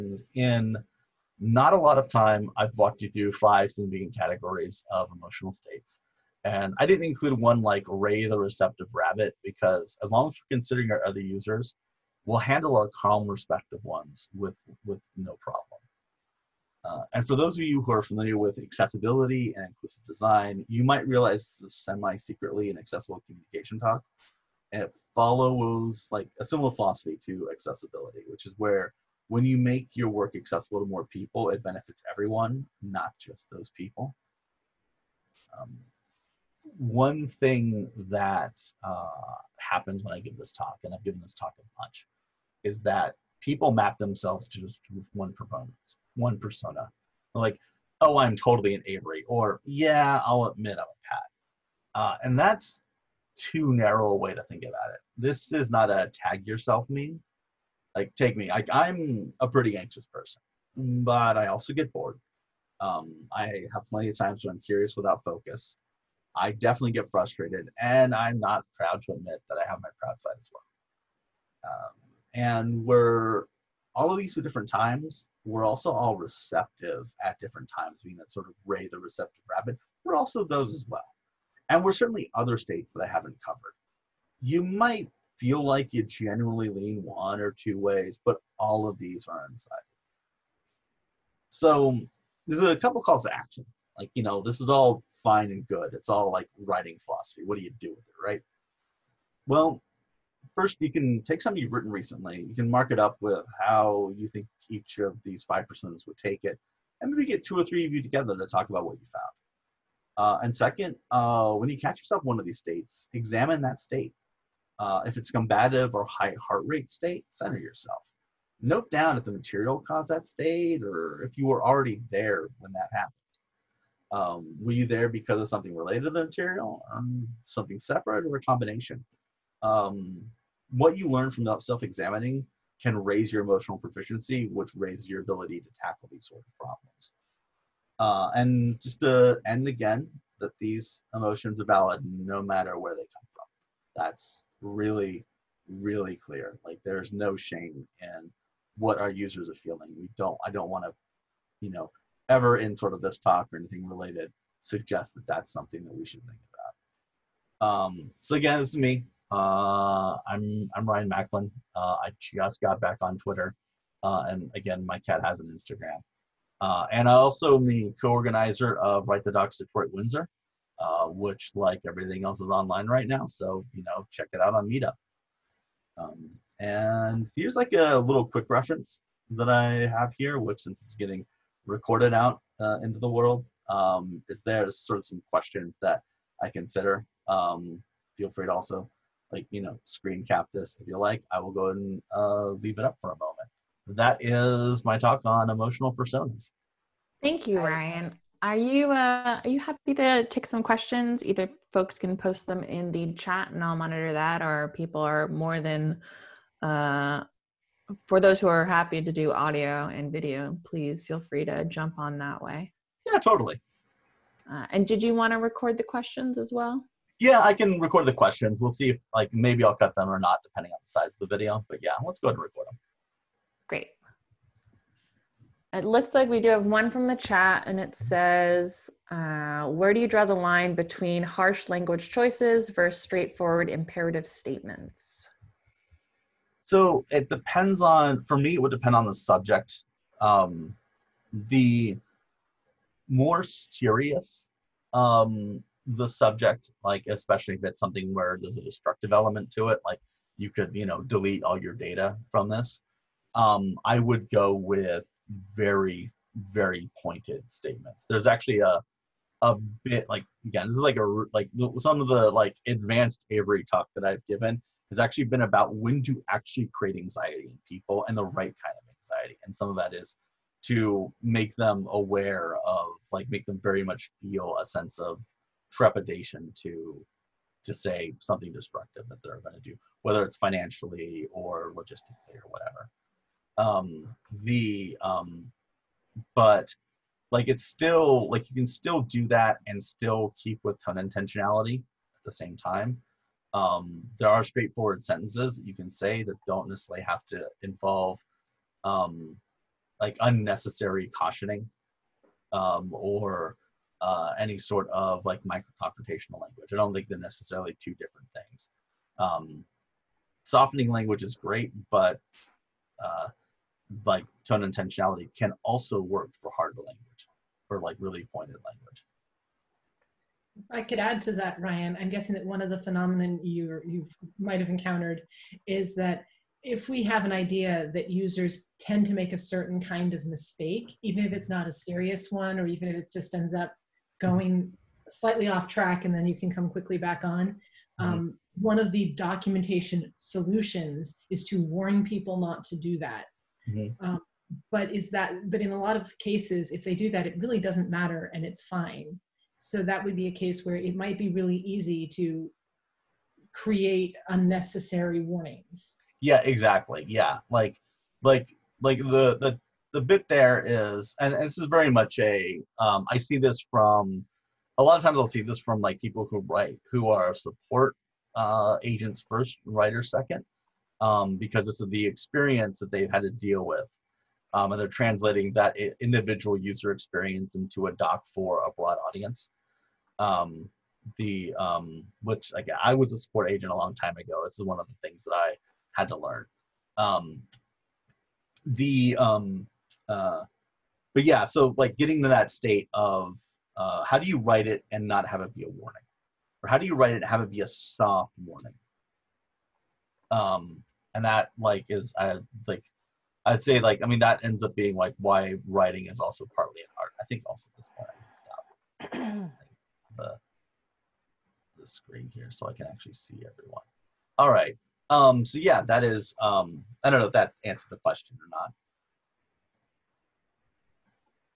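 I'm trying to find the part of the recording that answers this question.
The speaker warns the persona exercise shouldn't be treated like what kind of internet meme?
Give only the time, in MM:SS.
00:56.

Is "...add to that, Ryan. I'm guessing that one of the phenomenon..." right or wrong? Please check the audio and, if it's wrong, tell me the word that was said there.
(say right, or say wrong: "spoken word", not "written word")
right.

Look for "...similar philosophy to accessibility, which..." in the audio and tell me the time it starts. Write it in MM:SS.
00:26.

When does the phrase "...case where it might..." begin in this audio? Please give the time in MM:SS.
05:50.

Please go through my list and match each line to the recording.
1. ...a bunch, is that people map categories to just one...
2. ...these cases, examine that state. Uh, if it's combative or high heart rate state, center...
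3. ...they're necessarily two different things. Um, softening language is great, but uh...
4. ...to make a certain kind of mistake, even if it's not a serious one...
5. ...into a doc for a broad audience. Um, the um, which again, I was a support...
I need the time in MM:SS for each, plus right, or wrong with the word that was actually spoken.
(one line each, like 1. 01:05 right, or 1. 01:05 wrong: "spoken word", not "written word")
1. 00:41 wrong: "themselves", not "categories"
2. 01:52 wrong: "states", not "cases"
3. 05:07 right
4. 05:29 right
5. 06:17 right.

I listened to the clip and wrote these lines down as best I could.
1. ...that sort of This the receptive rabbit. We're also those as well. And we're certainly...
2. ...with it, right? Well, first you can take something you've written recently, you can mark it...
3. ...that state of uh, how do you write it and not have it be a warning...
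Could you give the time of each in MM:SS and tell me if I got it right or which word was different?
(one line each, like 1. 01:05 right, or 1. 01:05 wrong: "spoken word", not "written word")
1. 01:18 wrong: "Ray", not "This"
2. 01:37 right
3. 06:32 right.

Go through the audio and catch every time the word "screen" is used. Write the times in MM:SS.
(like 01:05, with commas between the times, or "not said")
03:09, 06:51.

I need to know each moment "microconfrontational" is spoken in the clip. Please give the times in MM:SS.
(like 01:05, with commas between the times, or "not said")
05:05.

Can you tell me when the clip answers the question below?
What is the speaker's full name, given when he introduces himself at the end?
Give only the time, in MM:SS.
02:40.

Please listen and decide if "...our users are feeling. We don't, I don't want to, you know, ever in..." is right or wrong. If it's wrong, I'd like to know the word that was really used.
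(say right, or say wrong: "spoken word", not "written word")
right.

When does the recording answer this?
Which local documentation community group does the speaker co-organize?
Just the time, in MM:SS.
02:49.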